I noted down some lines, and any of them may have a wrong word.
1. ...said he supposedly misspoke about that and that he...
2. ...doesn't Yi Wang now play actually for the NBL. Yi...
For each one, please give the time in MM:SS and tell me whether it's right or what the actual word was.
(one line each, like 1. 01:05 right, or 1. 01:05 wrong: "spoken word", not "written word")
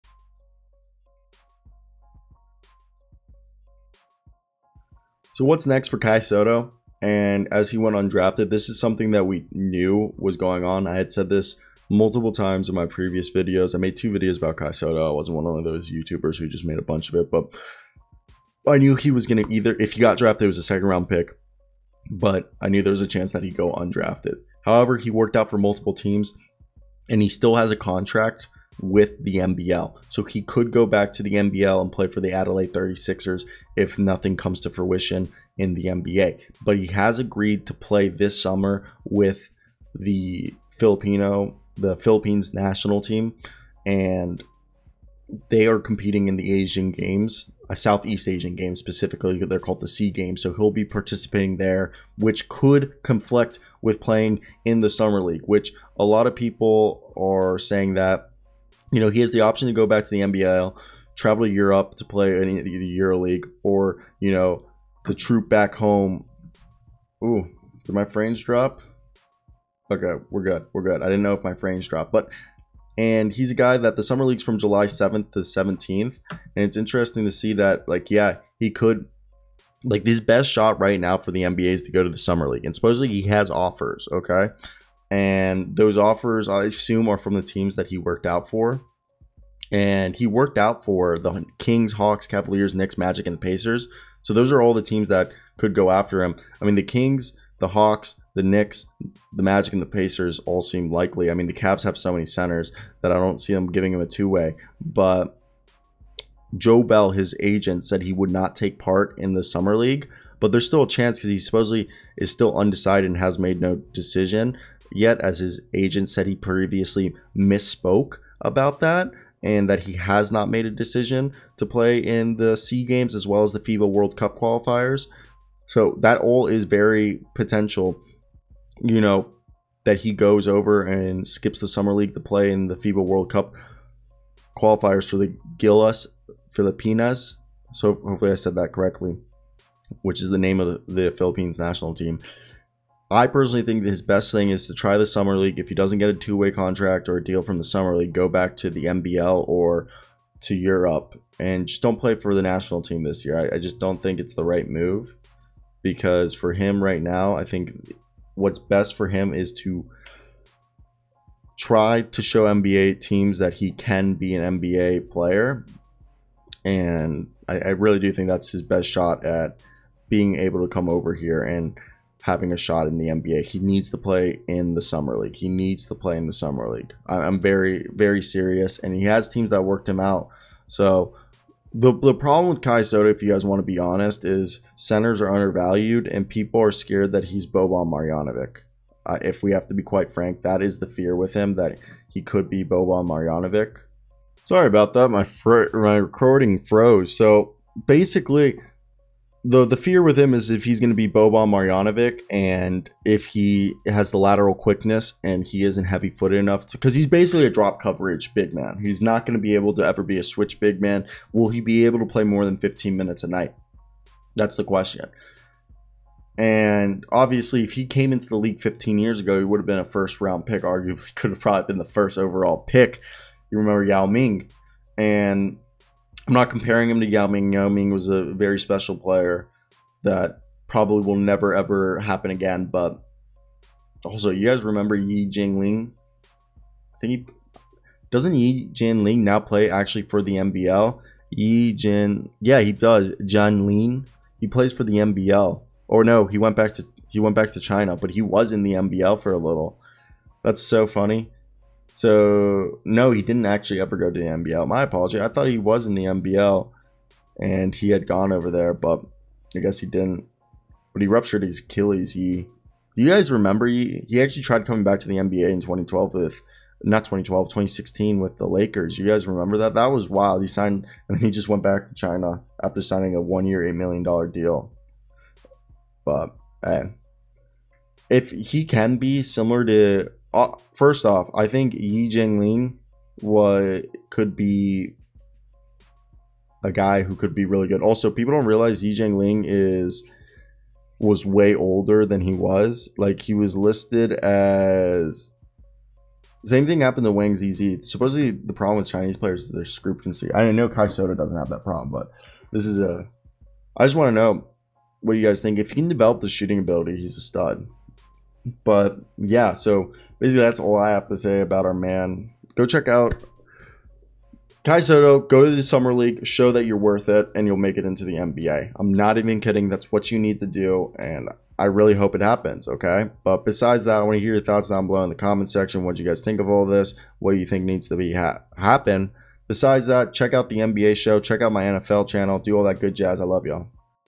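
1. 01:56 wrong: "previously", not "supposedly"
2. 03:58 wrong: "Jianlian", not "Wang".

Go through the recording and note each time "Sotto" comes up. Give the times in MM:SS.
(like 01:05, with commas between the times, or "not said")
00:06, 00:14, 03:02, 05:00, 05:14.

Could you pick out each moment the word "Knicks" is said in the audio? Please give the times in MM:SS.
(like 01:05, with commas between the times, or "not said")
01:32, 01:38.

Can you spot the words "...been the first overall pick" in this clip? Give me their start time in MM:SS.
03:41.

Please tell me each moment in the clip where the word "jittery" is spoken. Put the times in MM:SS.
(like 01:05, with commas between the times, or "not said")
not said.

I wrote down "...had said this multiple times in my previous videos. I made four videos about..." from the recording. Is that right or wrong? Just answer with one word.
wrong.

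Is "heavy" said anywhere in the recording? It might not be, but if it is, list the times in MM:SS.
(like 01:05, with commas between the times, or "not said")
03:25.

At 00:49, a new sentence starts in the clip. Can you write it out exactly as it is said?
They're called the Sea Games, so he'll be participating there, which could conflict with playing in the summer league.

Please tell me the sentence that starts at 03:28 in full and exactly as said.
He's not going to be able to ever be a switch big man.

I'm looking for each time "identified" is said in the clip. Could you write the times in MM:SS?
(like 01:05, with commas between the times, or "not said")
not said.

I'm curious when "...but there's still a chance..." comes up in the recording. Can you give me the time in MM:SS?
01:50.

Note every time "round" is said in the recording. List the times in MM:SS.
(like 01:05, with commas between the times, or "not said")
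00:20, 03:40.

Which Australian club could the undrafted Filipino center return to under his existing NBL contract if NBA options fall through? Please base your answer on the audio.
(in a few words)
Adelaide 36ers.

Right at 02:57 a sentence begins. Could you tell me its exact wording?
I'm very, very serious, and he has teams that worked him out.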